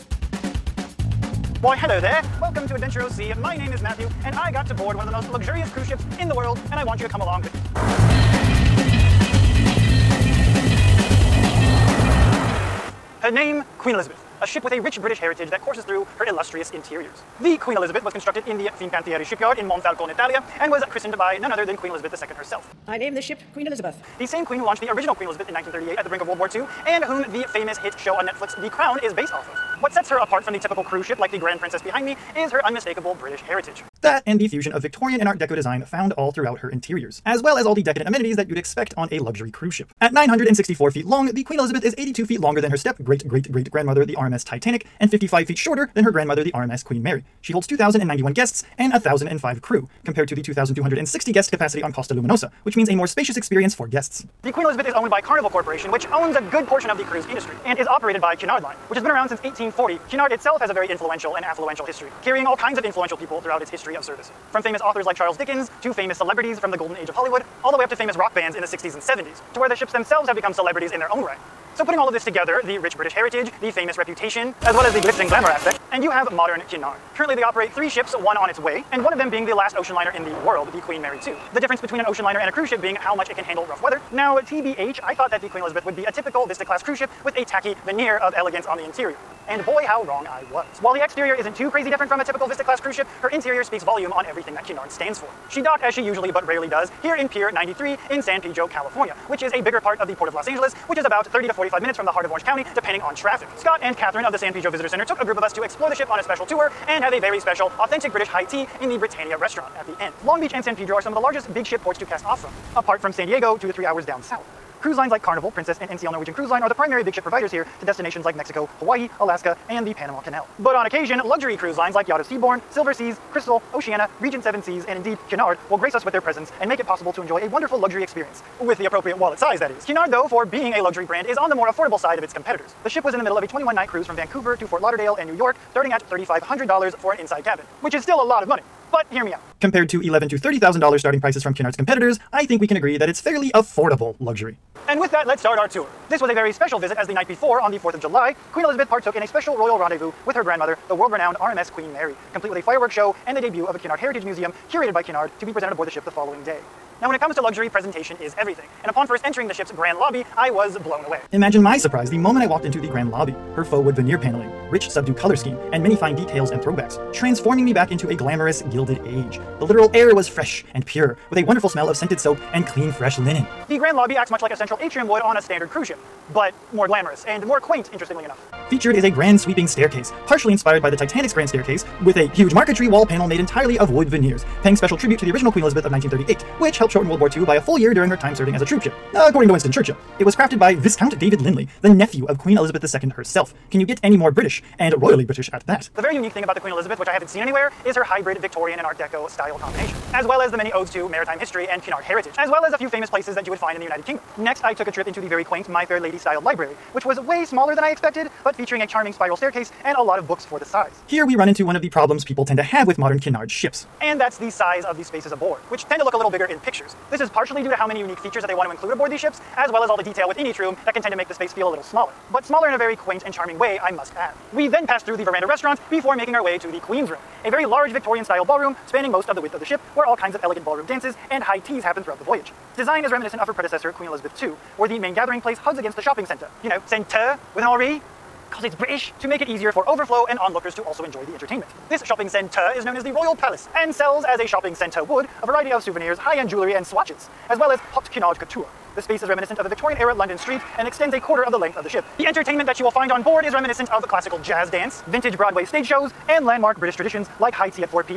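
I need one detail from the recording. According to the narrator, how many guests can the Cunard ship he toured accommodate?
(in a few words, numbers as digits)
2,091.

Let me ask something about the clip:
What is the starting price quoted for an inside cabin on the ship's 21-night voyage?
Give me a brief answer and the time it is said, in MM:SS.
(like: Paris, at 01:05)
$3,500, at 02:16.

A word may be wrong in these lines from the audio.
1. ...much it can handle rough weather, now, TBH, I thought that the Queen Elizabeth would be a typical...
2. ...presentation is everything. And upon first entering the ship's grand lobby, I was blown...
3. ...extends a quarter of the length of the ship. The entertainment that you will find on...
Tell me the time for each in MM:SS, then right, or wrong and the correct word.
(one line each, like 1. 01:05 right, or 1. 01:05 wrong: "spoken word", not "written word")
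1. 01:23 right
2. 02:37 right
3. 04:10 right.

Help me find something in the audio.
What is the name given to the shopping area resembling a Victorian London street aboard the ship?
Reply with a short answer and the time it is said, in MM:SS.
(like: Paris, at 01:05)
Royal Palace, at 04:03.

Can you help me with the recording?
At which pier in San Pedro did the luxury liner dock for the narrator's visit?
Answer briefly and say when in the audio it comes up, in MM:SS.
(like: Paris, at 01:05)
Pier 93, at 01:37.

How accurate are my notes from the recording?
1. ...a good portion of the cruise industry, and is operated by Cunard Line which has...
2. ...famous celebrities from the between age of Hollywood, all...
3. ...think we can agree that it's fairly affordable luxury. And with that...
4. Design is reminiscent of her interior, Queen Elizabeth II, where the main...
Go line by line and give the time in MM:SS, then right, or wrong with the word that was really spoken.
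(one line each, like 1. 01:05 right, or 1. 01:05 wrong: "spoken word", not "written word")
1. 00:56 right
2. 01:05 wrong: "golden", not "between"
3. 02:22 right
4. 03:52 wrong: "predecessor", not "interior".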